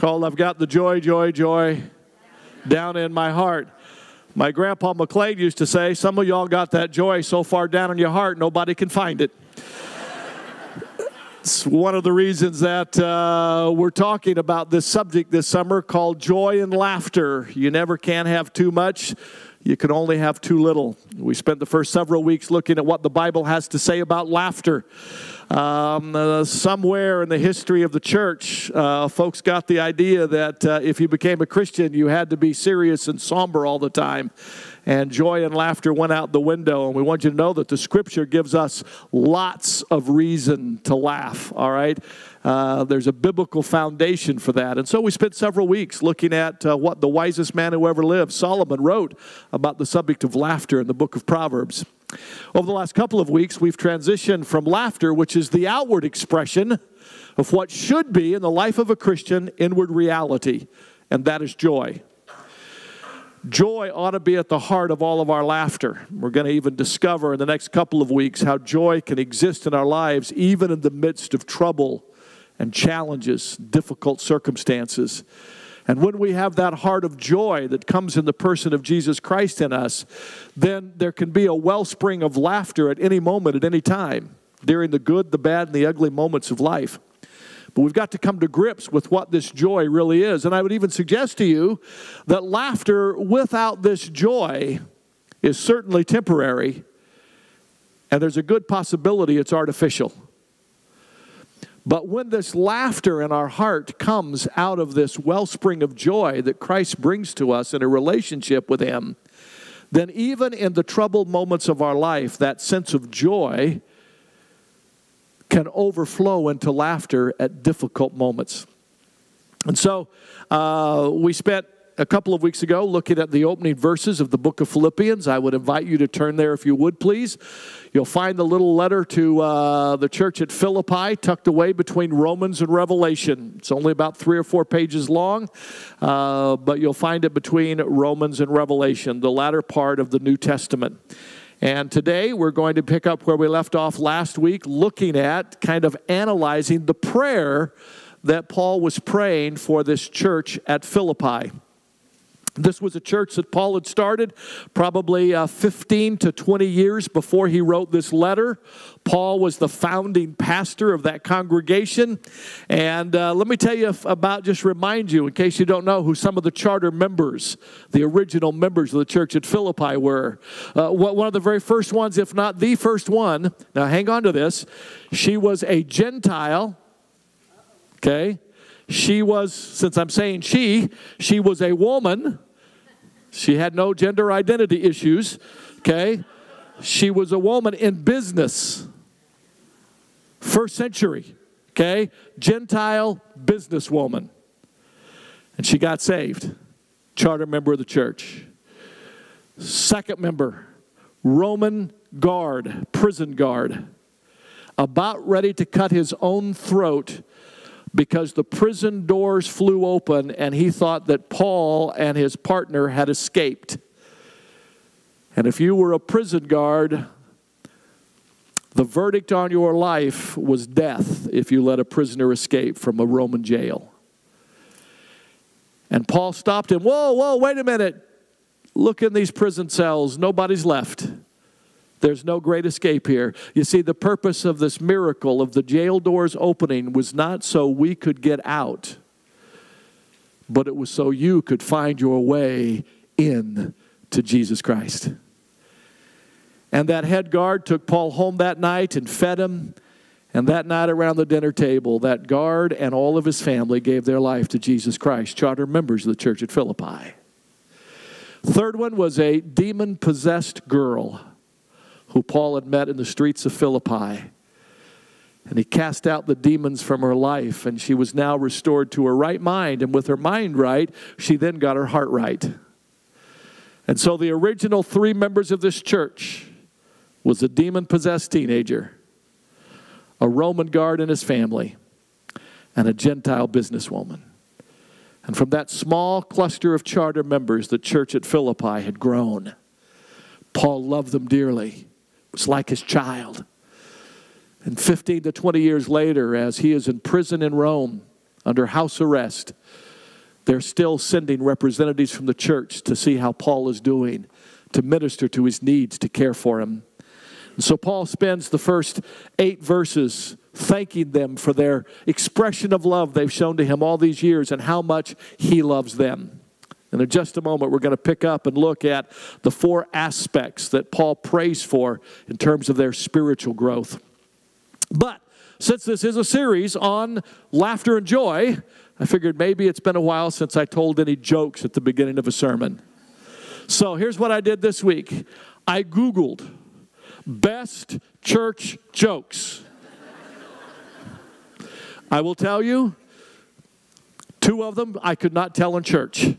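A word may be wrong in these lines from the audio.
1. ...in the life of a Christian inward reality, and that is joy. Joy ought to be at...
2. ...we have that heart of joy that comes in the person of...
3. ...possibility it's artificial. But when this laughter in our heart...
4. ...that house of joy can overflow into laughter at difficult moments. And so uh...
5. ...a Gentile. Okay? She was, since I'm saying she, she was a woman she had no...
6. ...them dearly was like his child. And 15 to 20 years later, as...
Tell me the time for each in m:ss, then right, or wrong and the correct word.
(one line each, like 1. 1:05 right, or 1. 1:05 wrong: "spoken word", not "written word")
1. 0:58 right
2. 1:16 right
3. 1:38 right
4. 1:52 wrong: "sense", not "house"
5. 2:55 right
6. 4:51 right.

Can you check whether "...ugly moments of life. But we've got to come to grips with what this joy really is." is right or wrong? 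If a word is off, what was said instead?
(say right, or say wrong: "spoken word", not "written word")
right.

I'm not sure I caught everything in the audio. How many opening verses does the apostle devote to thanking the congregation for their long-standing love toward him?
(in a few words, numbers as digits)
8.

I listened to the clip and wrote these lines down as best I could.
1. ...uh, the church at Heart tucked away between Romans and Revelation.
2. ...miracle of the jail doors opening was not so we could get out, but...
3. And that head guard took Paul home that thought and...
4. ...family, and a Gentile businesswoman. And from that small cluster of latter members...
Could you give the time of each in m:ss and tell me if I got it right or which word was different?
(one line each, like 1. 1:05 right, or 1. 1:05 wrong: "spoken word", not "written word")
1. 2:09 wrong: "Philippi", not "Heart"
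2. 3:54 right
3. 4:06 wrong: "night", not "thought"
4. 4:41 wrong: "charter", not "latter".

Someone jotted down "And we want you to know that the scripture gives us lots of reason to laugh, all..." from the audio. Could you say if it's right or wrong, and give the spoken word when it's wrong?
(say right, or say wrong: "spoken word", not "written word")
right.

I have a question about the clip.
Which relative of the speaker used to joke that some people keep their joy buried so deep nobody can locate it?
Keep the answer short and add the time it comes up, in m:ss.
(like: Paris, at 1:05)
Grandpa McLeod, at 0:04.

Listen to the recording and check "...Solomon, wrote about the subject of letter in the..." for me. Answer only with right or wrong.
wrong.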